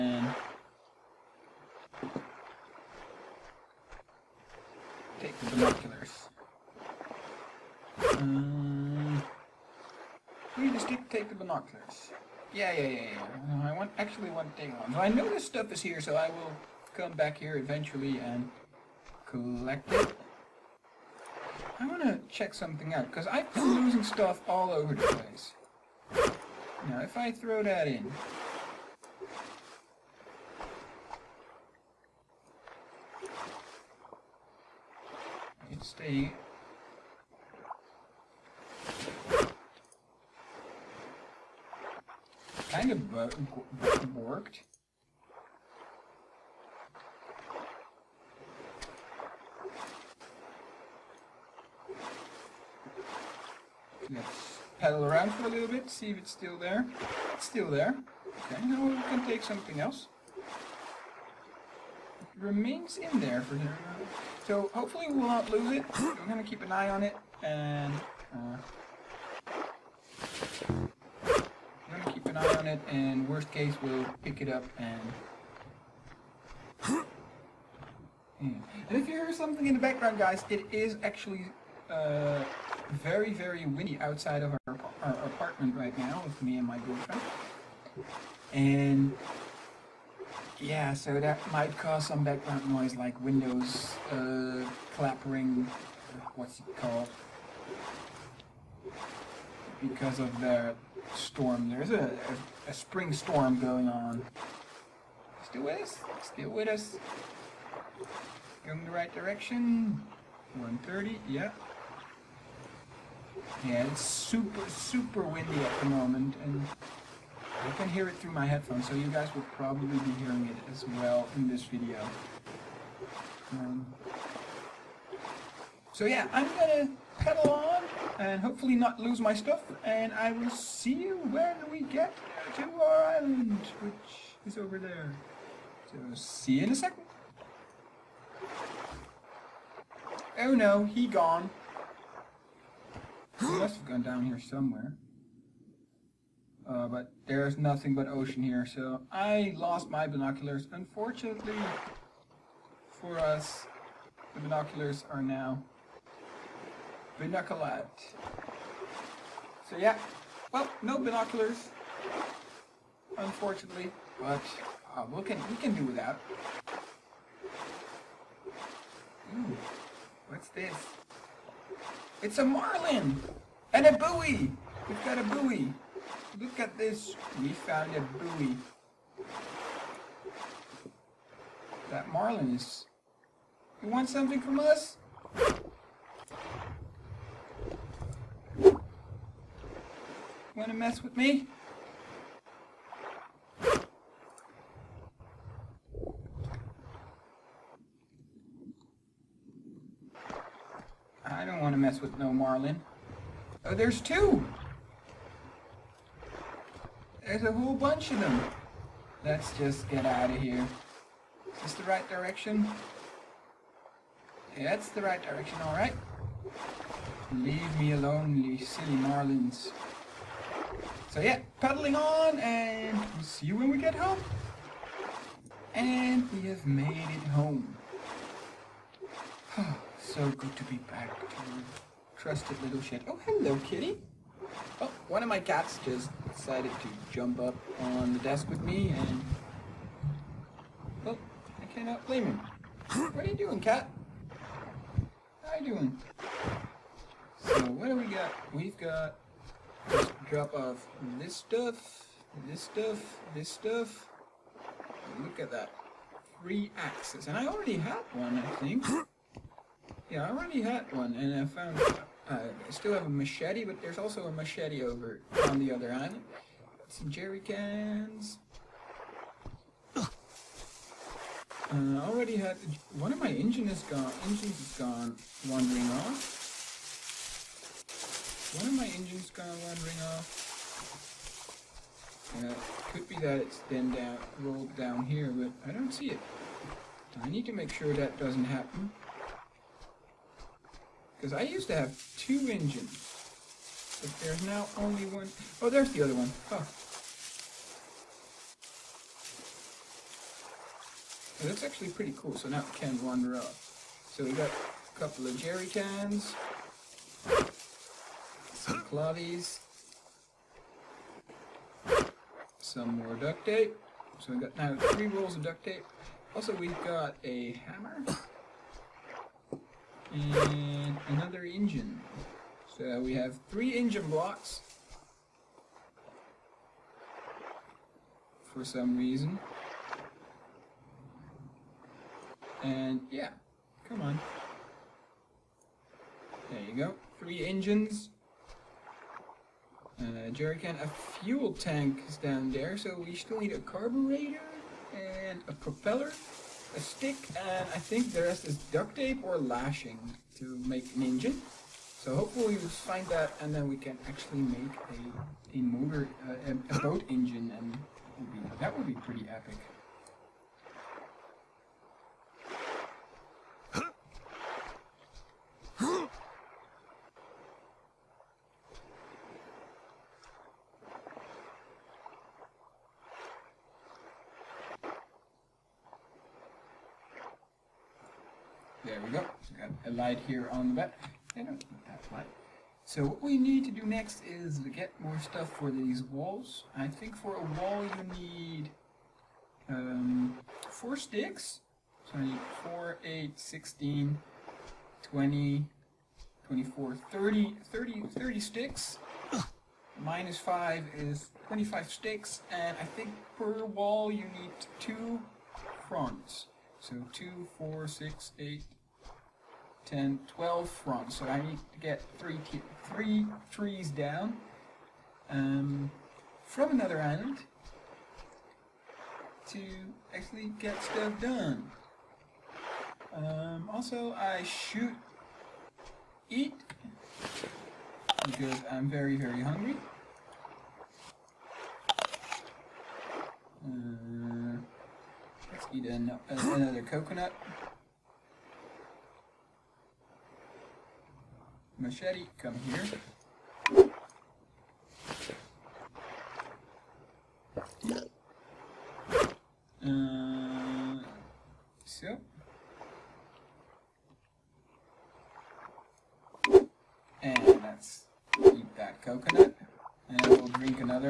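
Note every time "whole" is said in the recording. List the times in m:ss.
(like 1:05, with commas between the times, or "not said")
3:27.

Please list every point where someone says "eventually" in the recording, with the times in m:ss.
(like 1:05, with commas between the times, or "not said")
0:17.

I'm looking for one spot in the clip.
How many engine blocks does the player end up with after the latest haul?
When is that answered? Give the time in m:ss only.
5:23.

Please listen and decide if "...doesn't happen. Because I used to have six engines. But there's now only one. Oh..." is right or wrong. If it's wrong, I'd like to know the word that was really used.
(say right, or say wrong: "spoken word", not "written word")
wrong: "two", not "six".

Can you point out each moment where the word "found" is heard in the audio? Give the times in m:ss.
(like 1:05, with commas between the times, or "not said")
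2:57, 4:21.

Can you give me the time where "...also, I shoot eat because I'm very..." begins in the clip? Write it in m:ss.
7:03.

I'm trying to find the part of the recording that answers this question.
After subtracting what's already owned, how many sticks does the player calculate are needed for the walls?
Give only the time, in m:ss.
6:41.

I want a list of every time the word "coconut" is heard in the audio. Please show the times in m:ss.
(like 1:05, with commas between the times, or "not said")
7:16, 7:39.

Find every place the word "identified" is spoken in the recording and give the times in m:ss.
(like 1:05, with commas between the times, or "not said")
not said.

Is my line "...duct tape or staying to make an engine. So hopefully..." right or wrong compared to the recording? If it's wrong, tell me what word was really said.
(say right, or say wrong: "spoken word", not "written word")
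wrong: "lashing", not "staying".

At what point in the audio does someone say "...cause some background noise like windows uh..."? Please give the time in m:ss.
1:31.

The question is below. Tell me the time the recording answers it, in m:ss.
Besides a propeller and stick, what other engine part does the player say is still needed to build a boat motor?
5:43.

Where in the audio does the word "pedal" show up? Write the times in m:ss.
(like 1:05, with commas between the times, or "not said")
0:54, 2:07.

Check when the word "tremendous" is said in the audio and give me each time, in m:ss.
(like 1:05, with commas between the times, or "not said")
not said.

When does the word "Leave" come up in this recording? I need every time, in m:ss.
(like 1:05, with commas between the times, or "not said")
3:37.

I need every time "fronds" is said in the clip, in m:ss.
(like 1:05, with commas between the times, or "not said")
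6:45, 6:50.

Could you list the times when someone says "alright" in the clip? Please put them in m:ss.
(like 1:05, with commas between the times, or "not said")
3:35.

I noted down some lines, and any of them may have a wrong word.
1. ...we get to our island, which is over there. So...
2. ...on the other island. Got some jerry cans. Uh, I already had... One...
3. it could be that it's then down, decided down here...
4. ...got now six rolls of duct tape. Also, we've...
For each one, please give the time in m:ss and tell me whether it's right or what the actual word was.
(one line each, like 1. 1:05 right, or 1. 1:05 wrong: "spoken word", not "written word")
1. 2:11 right
2. 4:25 right
3. 4:42 wrong: "rolled", not "decided"
4. 5:14 wrong: "three", not "six".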